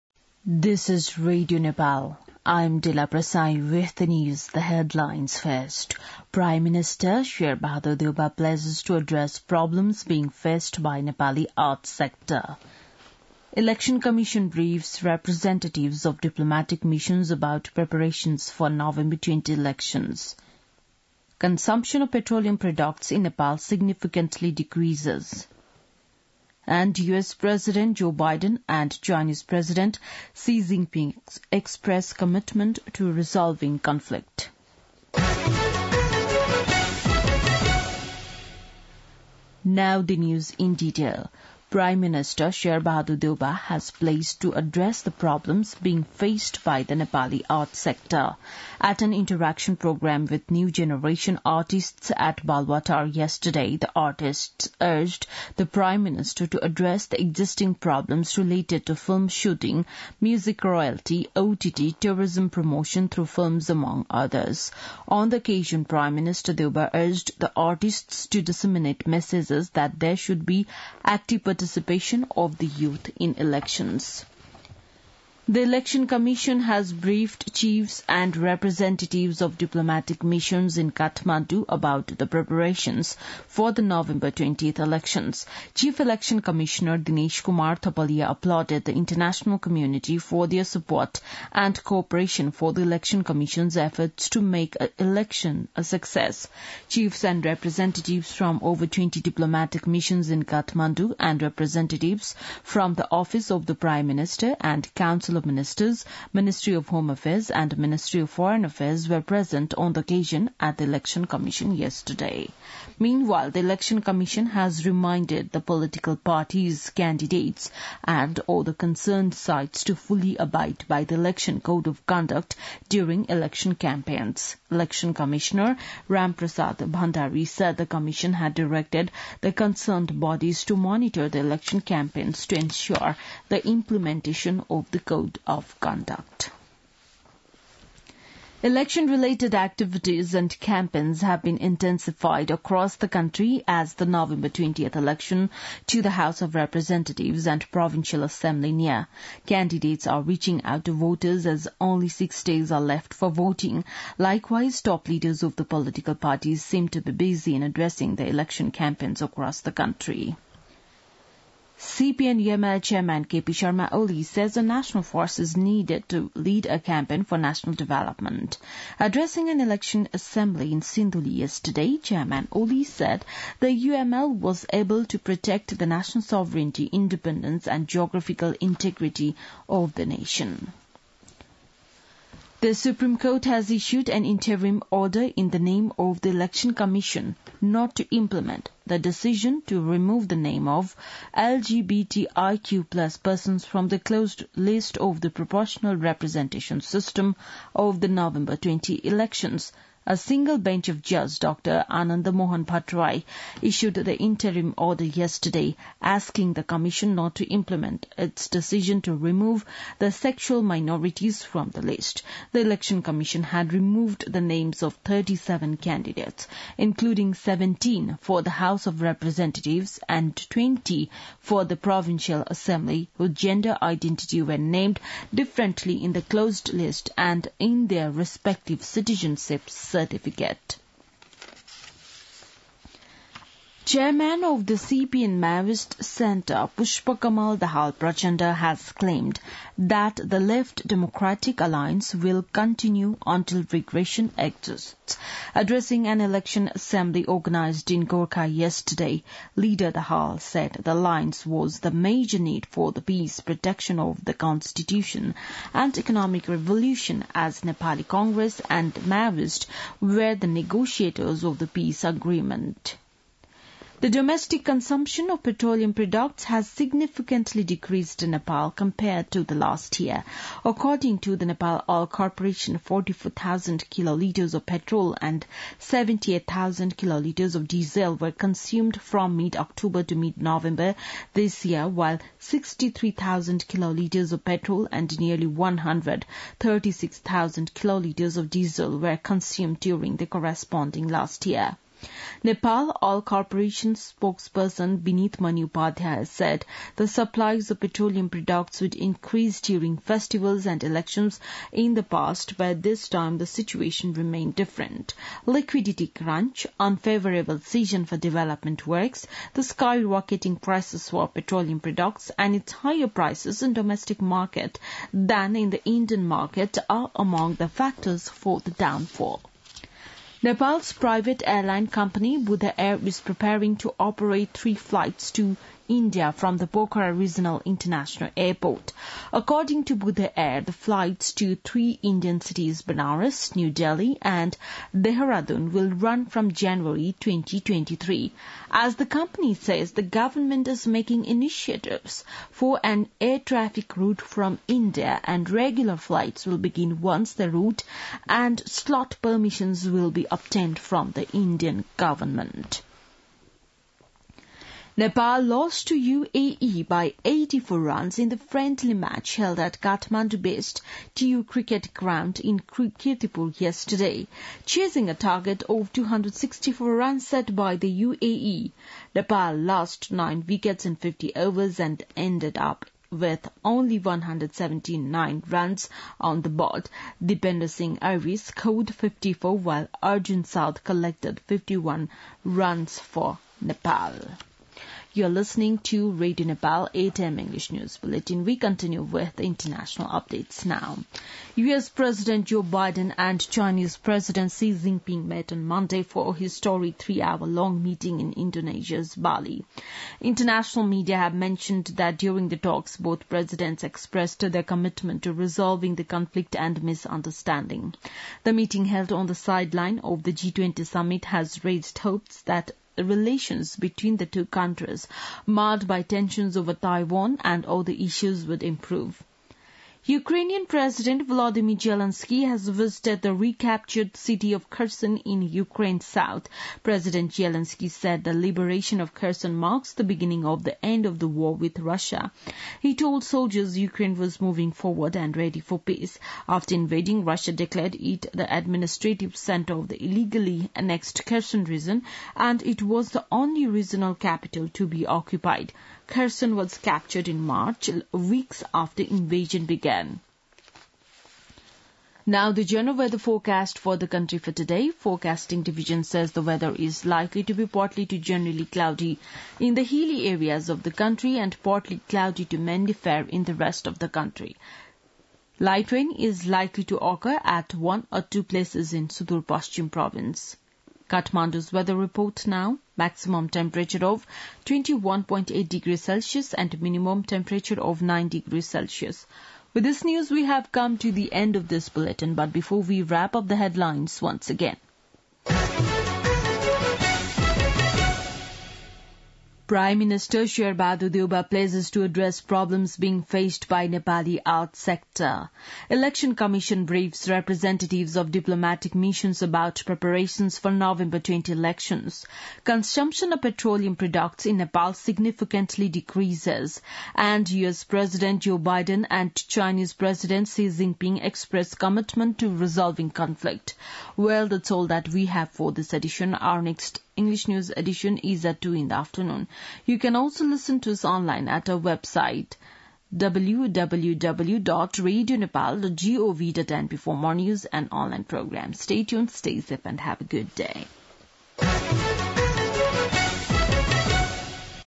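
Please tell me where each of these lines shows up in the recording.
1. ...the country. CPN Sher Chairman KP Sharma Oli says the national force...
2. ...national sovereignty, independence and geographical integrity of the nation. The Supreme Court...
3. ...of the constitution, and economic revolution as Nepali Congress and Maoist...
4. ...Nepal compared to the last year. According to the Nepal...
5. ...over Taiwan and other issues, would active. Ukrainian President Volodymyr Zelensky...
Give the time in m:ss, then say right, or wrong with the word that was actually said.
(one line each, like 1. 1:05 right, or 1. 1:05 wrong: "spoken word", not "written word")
1. 2:39 wrong: "UML", not "Sher"
2. 2:55 right
3. 4:13 right
4. 4:28 right
5. 6:56 wrong: "improve", not "active".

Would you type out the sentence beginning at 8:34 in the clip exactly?
Well, that's all that we have for this edition.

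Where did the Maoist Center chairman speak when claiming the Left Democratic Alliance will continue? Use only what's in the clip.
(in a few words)
Gorkha.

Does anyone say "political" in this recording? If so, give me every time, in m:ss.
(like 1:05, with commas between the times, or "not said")
1:55, 2:35.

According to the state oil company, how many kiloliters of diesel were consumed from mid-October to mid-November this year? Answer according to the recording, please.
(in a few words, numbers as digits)
78,000.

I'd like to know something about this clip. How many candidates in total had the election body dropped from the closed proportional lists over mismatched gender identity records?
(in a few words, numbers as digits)
37.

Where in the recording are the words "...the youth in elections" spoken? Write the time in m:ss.
1:12.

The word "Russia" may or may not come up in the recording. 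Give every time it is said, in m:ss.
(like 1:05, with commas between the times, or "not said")
7:11, 7:17.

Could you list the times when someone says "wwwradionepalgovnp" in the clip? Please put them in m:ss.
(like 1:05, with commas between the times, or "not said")
8:43.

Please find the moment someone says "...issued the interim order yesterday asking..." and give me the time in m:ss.
3:23.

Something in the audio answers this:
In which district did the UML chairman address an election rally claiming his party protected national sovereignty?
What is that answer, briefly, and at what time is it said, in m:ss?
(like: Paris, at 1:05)
Sindhuli, at 2:50.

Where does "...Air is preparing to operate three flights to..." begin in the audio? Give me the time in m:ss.
5:22.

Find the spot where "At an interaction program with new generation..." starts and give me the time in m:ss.
0:48.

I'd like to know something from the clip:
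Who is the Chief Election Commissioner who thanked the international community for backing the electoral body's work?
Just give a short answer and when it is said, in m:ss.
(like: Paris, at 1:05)
Dinesh Kumar Thapalia, at 1:26.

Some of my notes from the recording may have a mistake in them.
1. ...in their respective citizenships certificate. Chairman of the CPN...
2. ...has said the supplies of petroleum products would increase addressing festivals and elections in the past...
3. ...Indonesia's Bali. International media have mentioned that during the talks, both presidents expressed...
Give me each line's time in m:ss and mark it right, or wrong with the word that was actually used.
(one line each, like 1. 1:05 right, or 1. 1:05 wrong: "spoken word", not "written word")
1. 3:47 right
2. 4:56 wrong: "during", not "addressing"
3. 6:38 right.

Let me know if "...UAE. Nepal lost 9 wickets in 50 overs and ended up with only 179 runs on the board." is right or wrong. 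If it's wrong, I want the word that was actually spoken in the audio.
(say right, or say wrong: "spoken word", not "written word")
right.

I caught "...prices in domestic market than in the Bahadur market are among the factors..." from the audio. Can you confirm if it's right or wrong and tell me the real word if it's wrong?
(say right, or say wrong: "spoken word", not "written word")
wrong: "Indian", not "Bahadur".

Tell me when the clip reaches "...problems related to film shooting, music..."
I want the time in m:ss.
0:57.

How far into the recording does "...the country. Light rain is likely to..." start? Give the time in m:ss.
7:43.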